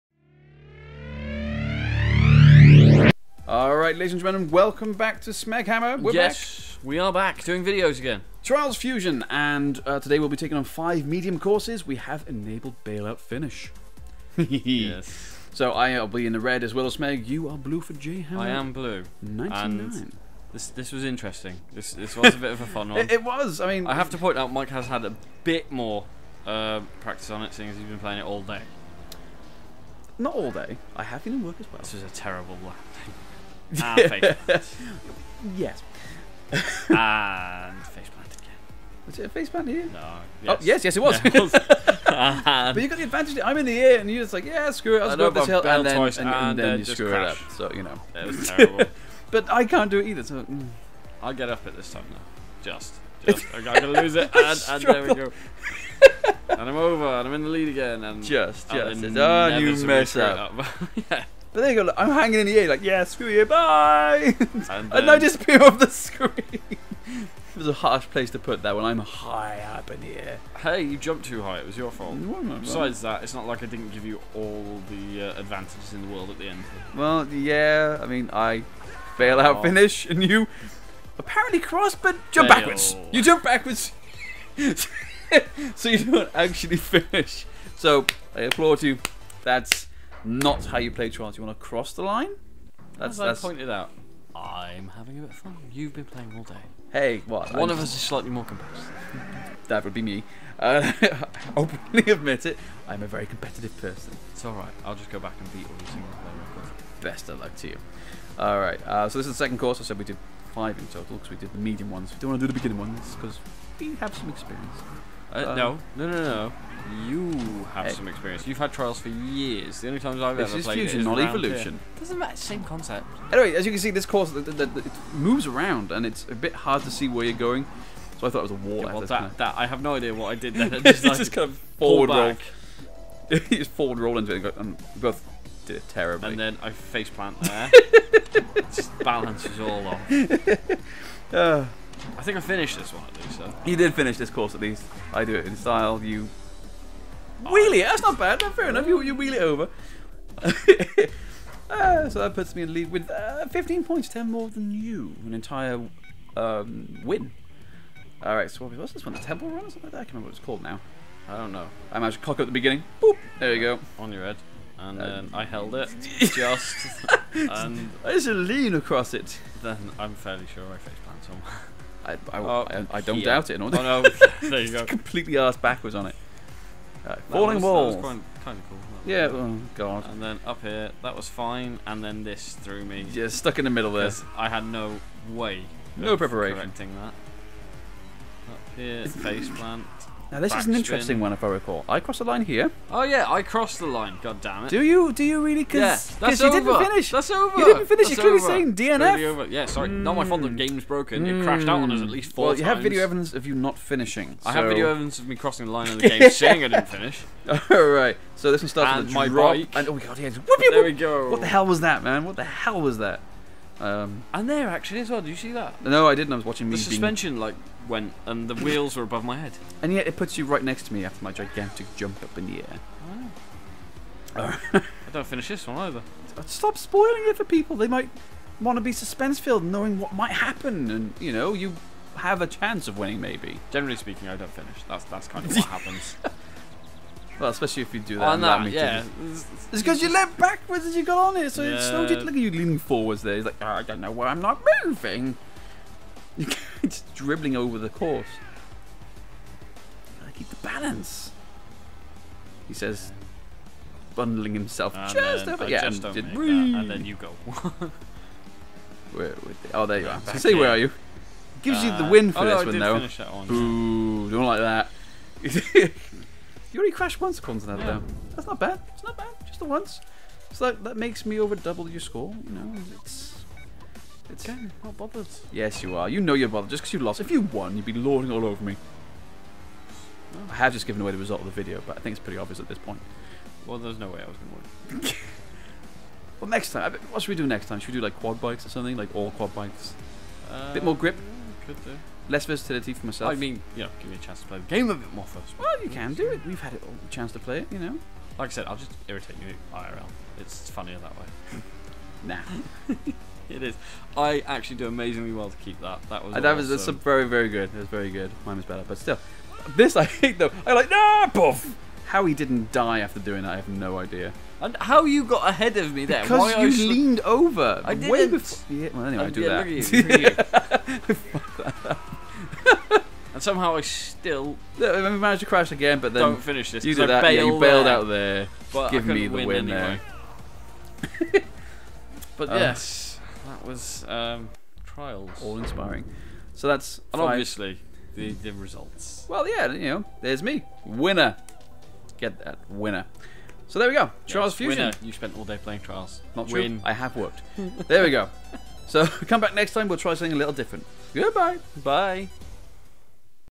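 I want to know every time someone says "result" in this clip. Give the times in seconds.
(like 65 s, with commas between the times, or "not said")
281 s, 338 s.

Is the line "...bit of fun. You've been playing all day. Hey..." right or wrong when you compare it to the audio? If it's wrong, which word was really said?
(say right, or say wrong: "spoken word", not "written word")
right.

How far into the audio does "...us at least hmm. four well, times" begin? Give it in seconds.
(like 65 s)
201 s.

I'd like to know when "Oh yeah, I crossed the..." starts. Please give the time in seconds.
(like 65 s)
192 s.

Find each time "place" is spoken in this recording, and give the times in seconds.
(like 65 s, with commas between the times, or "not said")
68 s.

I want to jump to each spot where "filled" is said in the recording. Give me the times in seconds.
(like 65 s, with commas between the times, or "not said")
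229 s.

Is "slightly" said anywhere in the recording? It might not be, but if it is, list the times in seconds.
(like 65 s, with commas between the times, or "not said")
98 s.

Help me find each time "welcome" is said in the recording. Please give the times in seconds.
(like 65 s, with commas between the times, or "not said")
4 s.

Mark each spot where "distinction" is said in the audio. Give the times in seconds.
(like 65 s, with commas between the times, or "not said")
not said.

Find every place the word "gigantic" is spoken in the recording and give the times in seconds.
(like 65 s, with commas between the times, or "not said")
221 s.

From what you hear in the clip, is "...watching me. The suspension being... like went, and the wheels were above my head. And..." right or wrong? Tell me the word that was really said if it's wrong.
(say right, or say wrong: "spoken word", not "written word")
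right.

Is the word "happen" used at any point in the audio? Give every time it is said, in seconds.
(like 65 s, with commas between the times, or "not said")
230 s, 235 s.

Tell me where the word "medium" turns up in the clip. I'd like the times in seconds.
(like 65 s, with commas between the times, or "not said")
11 s, 111 s.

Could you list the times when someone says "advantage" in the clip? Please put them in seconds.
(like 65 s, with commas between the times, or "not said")
43 s, 75 s.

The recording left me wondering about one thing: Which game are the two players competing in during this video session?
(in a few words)
Trials Fusion.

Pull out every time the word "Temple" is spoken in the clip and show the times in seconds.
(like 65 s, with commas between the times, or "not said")
159 s.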